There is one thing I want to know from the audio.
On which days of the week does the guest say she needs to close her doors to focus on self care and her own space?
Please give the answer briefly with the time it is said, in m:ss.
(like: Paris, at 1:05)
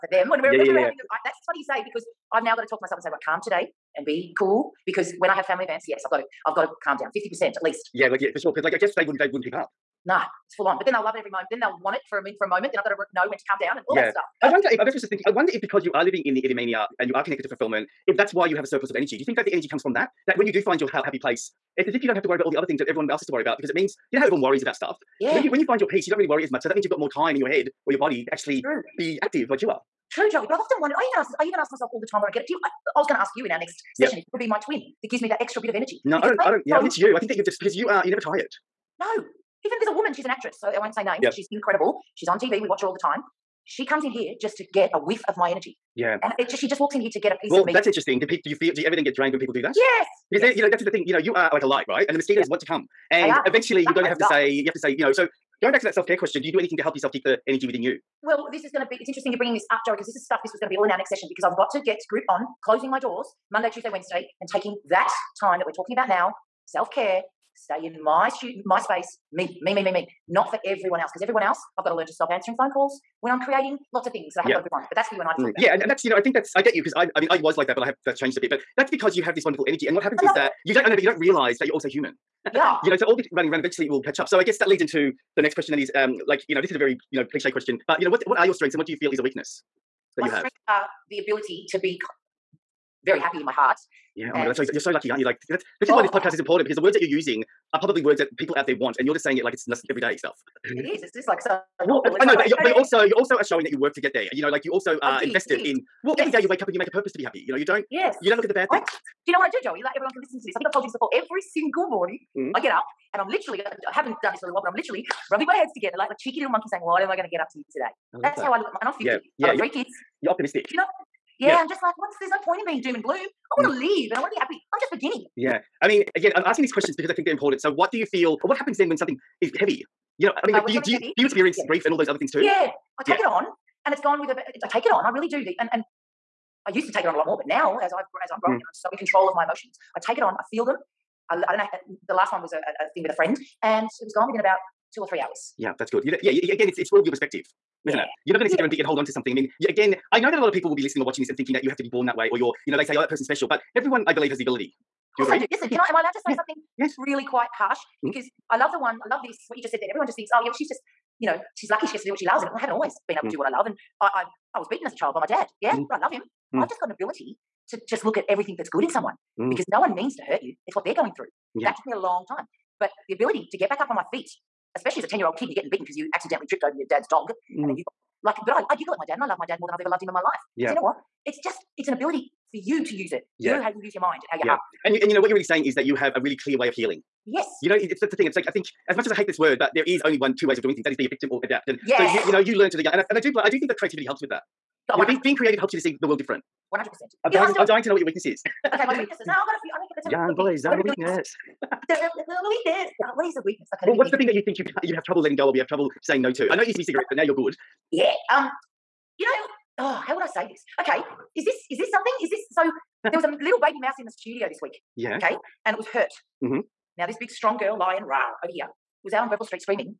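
Monday, Tuesday, Wednesday, at 1:03.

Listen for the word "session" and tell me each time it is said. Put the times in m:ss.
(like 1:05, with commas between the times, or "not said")
0:33, 1:01.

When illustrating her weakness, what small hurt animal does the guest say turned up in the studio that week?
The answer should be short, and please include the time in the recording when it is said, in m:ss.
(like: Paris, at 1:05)
baby mouse, at 3:33.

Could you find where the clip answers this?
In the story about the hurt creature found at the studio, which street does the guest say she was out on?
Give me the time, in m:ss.
3:39.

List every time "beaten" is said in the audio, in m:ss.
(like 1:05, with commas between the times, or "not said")
2:44, 2:55.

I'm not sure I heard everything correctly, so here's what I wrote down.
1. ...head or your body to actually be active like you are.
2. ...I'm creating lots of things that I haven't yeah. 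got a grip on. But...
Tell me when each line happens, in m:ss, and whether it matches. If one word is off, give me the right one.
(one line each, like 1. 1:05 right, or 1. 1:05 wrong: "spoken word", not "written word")
1. 0:27 right
2. 1:13 right.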